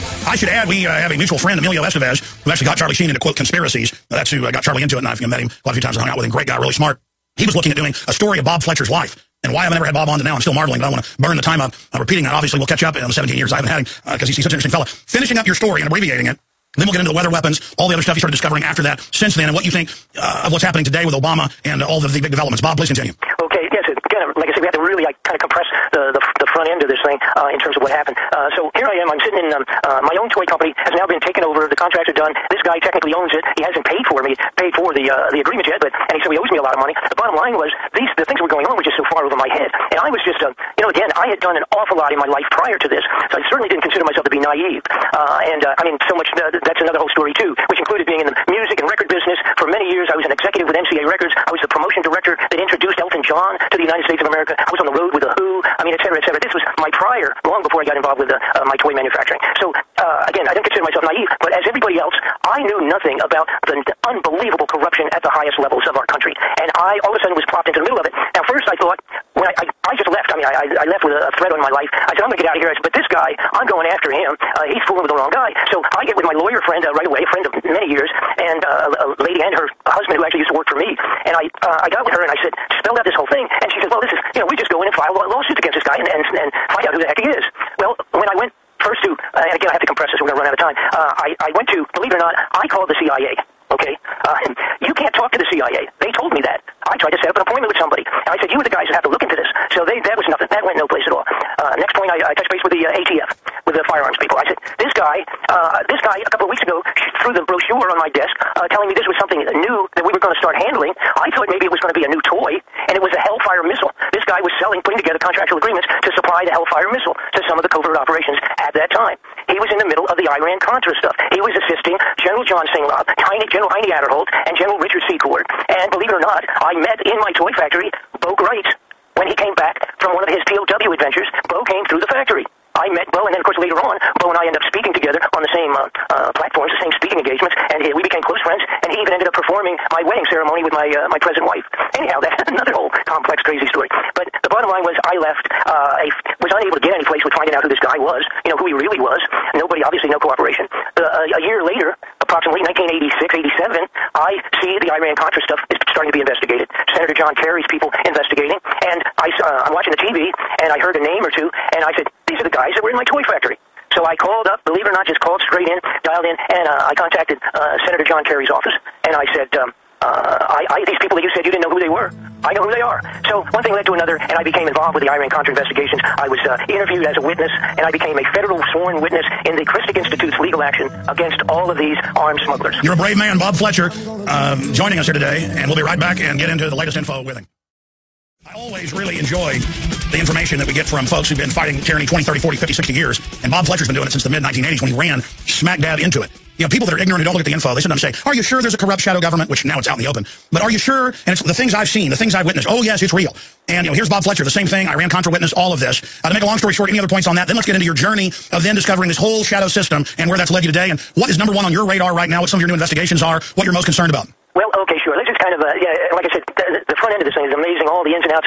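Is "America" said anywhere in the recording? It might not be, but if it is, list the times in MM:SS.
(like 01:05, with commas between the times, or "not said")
00:54.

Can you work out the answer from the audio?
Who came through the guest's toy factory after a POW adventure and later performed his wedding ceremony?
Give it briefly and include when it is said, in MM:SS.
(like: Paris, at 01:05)
Bo Wright, at 02:08.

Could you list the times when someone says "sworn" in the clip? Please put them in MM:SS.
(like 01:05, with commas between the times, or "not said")
02:58.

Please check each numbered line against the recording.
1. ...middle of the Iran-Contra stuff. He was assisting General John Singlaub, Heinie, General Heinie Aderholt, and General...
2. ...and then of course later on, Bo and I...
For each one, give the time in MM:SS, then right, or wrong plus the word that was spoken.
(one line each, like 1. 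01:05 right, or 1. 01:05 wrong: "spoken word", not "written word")
1. 01:59 right
2. 02:13 right.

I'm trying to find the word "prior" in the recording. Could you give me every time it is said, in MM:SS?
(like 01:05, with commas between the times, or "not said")
00:42, 00:56.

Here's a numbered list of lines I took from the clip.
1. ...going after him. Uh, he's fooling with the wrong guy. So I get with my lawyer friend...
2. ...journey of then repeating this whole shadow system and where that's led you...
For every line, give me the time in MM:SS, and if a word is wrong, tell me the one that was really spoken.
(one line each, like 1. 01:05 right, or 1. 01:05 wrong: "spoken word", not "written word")
1. 01:13 right
2. 03:27 wrong: "discovering", not "repeating".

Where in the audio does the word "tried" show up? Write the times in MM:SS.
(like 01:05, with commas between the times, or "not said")
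01:36.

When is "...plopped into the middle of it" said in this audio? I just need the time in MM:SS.
01:07.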